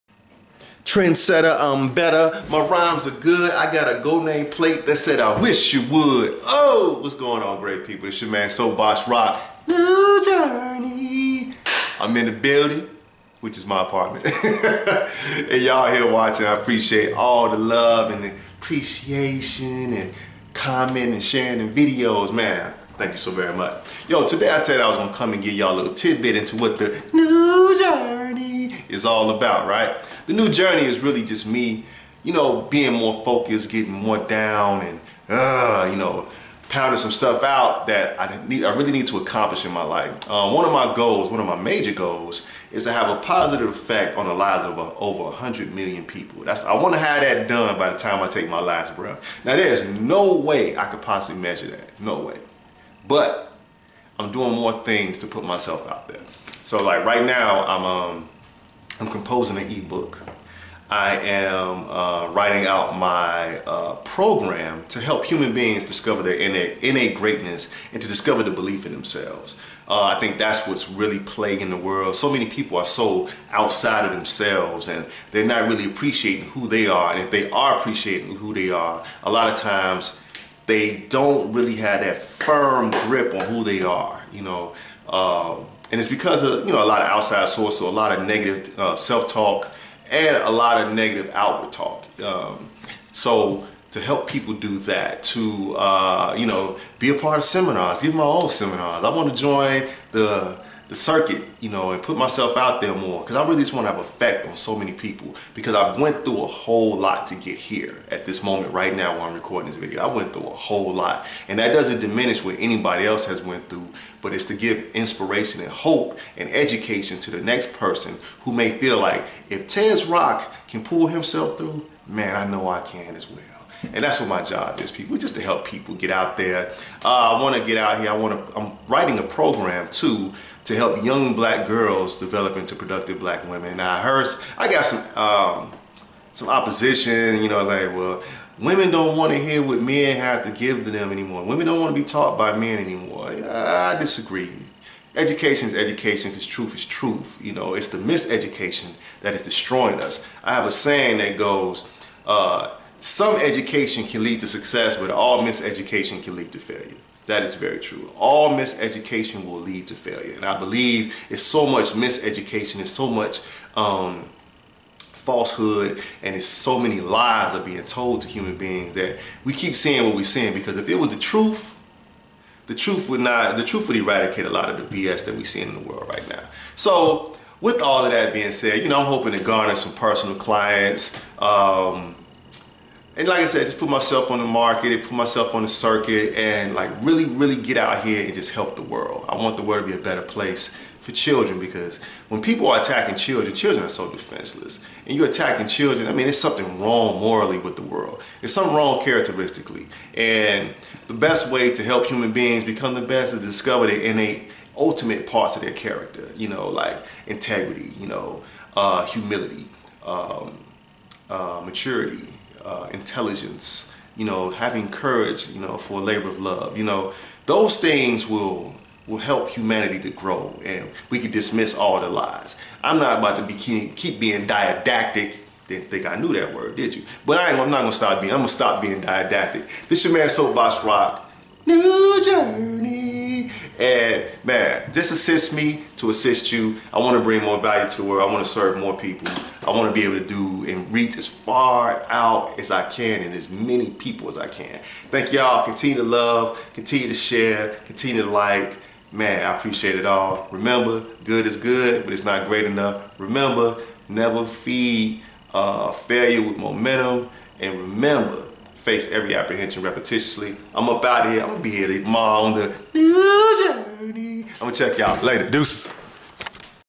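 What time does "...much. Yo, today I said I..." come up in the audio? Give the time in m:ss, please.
0:23.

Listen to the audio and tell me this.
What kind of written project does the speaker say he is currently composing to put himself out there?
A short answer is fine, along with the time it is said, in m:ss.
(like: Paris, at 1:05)
ebook, at 0:59.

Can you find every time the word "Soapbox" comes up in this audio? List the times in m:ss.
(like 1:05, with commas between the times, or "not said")
0:08, 3:50.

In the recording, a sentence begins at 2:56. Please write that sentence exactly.
So, with all of that being said, you know, I'm hoping to garner some personal clients.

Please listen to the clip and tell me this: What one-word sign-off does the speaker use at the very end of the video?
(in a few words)
Deuces.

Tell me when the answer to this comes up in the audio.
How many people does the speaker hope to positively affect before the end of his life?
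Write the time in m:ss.
0:45.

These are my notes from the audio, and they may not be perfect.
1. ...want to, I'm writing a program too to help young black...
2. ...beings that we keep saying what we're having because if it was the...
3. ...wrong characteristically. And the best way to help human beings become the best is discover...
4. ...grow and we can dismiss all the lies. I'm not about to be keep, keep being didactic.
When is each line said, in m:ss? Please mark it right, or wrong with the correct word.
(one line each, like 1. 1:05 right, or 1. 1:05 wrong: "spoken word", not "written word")
1. 2:08 right
2. 2:48 wrong: "saying", not "having"
3. 3:18 right
4. 3:40 right.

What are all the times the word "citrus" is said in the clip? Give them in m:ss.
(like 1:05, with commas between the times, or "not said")
not said.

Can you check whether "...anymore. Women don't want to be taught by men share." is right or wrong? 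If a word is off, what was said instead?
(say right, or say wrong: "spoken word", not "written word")
wrong: "anymore", not "share".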